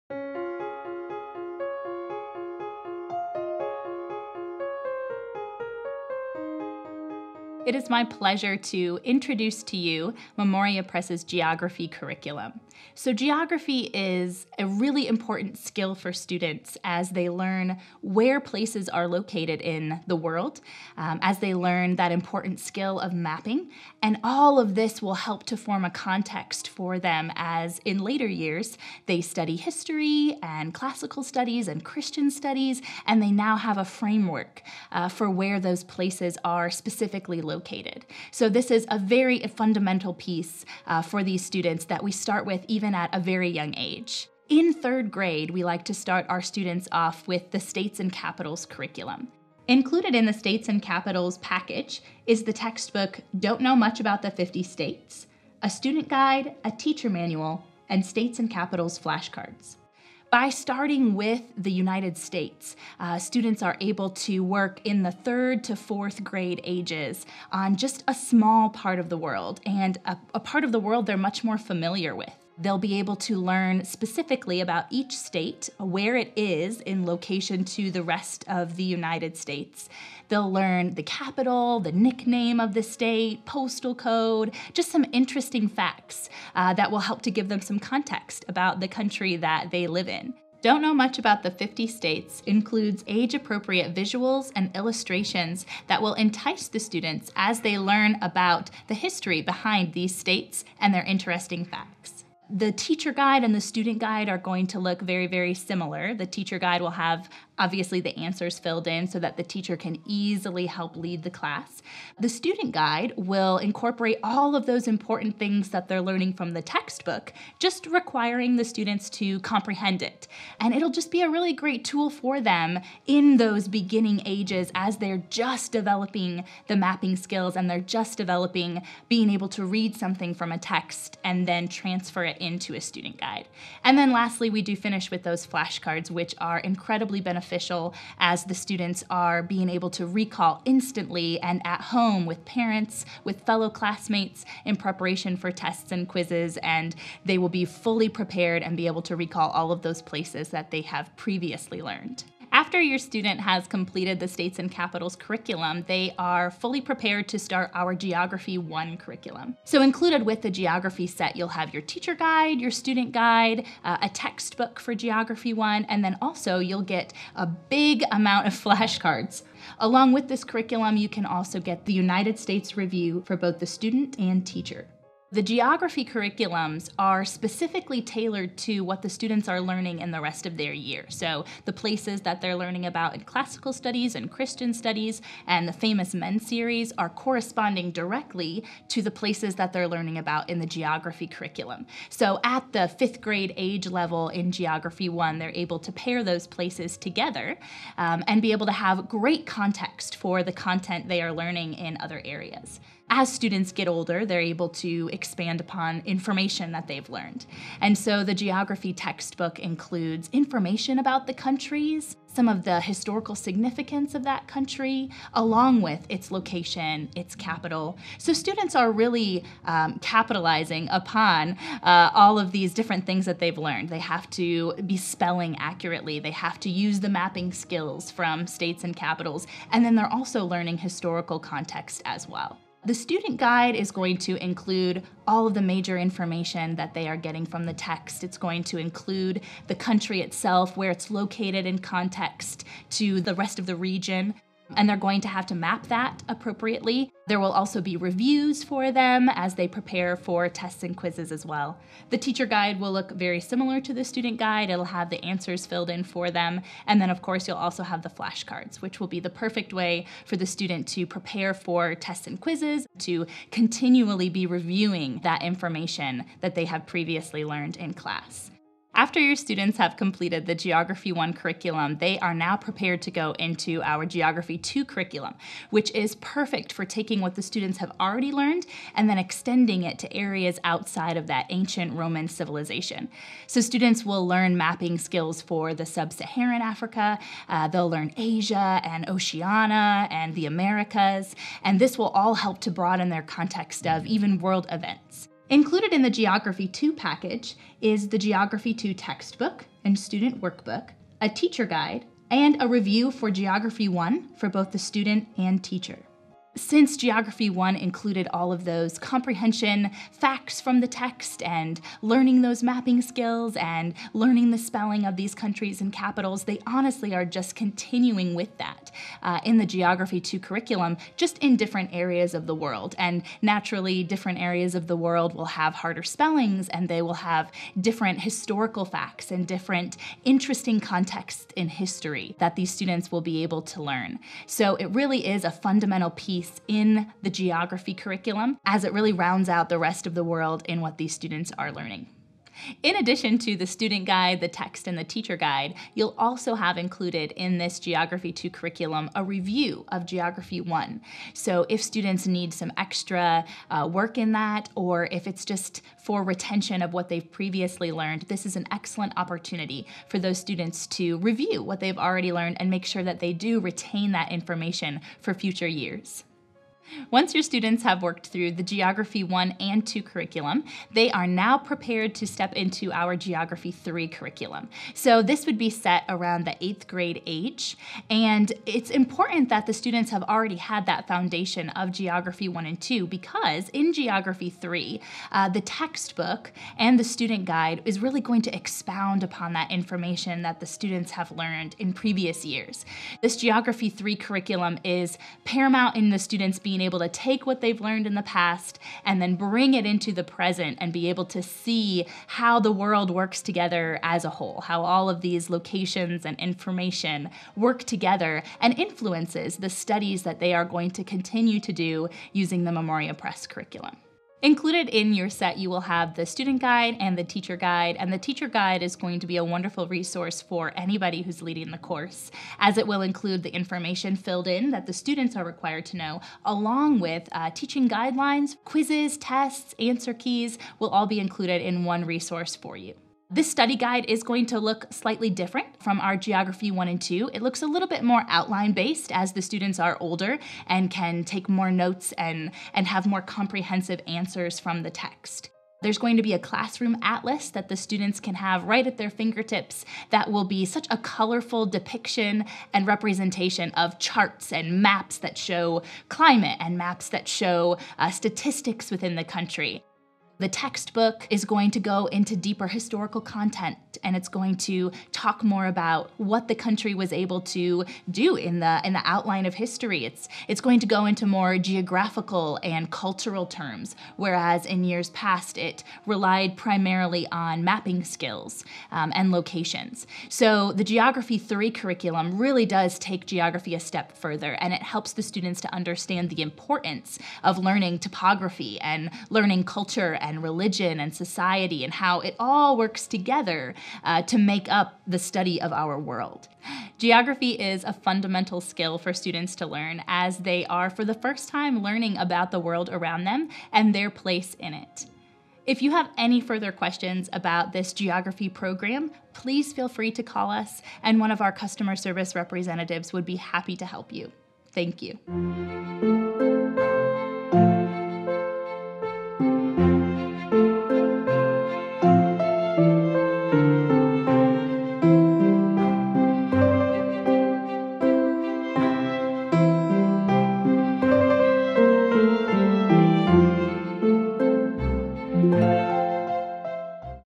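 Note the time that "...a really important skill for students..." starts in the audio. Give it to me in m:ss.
0:14.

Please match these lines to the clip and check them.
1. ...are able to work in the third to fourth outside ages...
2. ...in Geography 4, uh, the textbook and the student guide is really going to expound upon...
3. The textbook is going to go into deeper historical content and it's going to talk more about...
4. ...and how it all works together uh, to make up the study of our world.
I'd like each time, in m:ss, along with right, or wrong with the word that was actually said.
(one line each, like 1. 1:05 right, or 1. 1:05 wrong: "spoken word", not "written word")
1. 1:03 wrong: "grade", not "outside"
2. 6:23 wrong: "3", not "4"
3. 7:40 right
4. 8:11 right.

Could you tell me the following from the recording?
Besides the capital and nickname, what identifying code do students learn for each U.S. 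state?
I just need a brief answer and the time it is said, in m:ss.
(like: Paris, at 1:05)
postal code, at 1:23.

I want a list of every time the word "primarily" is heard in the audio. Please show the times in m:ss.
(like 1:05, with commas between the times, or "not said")
7:56.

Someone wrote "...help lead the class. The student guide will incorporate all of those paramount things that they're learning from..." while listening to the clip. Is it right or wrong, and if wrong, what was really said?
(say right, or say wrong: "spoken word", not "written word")
wrong: "important", not "paramount".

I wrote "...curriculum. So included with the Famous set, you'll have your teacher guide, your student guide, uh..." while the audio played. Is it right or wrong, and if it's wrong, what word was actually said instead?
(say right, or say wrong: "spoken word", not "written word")
wrong: "Geography", not "Famous".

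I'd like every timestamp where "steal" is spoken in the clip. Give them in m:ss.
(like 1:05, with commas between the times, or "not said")
not said.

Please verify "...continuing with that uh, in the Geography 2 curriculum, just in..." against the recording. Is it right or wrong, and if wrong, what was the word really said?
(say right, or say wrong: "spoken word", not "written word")
right.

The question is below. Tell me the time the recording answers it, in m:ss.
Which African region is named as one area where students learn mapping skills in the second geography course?
4:45.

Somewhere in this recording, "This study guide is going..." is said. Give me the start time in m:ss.
7:13.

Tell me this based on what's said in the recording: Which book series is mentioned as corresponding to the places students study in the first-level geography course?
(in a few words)
Famous Men series.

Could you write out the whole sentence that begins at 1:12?
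They'll be able to learn specifically about each state, where it is in location to the rest of the United States.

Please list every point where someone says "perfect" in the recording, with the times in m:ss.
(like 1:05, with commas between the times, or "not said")
4:19, 4:36.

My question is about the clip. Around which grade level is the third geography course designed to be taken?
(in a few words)
eighth grade.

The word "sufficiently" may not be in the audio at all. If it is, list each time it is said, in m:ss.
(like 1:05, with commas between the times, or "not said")
not said.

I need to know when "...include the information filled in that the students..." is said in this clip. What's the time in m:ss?
7:03.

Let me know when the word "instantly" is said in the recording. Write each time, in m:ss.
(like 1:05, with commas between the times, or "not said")
2:20.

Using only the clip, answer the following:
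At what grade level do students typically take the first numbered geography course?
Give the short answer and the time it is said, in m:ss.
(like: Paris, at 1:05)
fifth grade, at 3:12.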